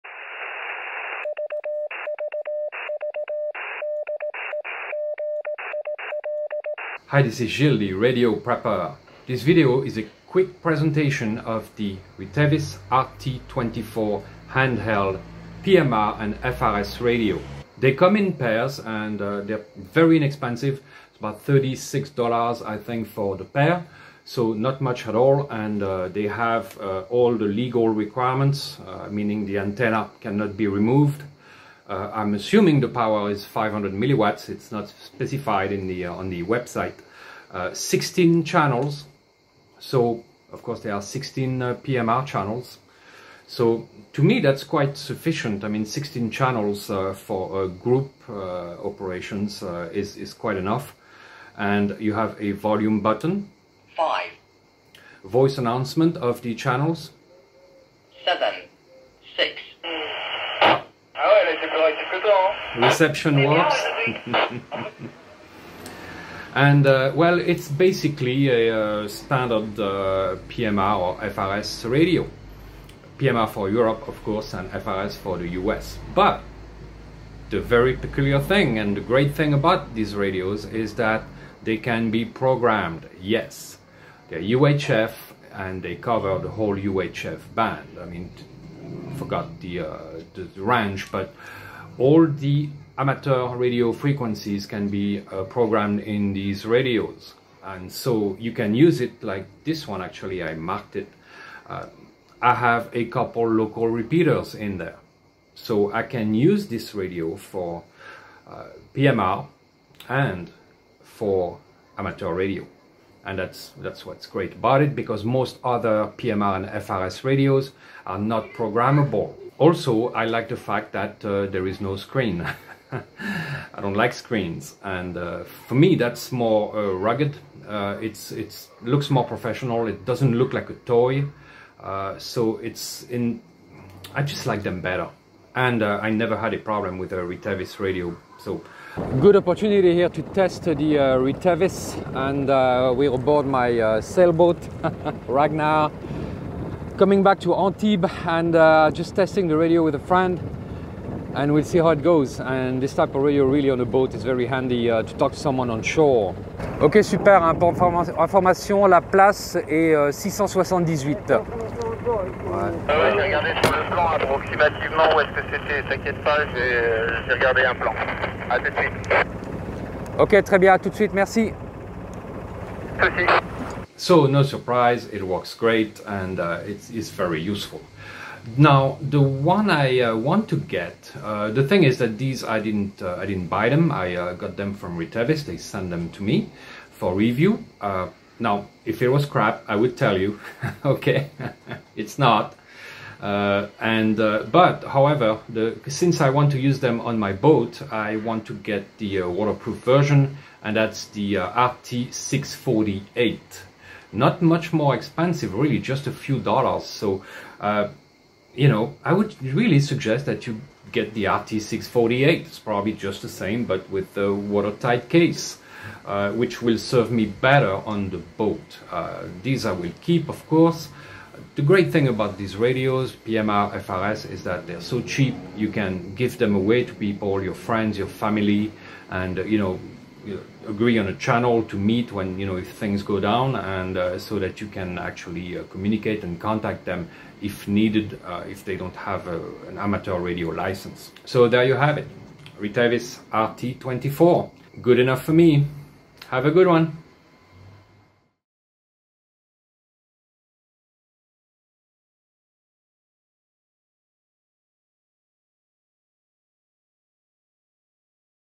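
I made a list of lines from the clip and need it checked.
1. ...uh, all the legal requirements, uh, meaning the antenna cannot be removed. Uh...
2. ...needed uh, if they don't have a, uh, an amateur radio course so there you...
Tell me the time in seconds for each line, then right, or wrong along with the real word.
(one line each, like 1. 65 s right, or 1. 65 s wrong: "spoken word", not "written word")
1. 26 s right
2. 237 s wrong: "license", not "course".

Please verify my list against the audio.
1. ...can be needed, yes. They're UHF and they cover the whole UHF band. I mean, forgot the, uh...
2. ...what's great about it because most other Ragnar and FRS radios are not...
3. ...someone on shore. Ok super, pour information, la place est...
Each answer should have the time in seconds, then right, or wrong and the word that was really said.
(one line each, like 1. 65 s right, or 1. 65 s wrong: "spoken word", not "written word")
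1. 81 s wrong: "programmed", not "needed"
2. 114 s wrong: "PMR", not "Ragnar"
3. 155 s right.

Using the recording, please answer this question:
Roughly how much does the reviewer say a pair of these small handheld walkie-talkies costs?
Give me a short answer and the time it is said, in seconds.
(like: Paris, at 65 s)
$36, at 21 s.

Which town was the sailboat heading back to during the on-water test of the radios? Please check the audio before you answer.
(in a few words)
Antibes.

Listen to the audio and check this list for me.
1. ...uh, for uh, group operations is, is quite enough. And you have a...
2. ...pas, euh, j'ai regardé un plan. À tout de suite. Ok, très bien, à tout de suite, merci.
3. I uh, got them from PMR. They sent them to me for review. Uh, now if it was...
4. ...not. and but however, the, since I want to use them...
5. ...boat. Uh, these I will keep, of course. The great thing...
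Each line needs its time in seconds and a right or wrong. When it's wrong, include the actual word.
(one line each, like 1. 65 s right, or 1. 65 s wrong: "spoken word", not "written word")
1. 46 s right
2. 166 s right
3. 183 s wrong: "Retevis", not "PMR"
4. 192 s right
5. 218 s right.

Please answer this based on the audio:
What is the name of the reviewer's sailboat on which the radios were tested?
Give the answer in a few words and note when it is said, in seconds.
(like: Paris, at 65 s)
Ragnar, at 145 s.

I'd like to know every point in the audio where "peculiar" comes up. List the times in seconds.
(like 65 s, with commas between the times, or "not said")
77 s.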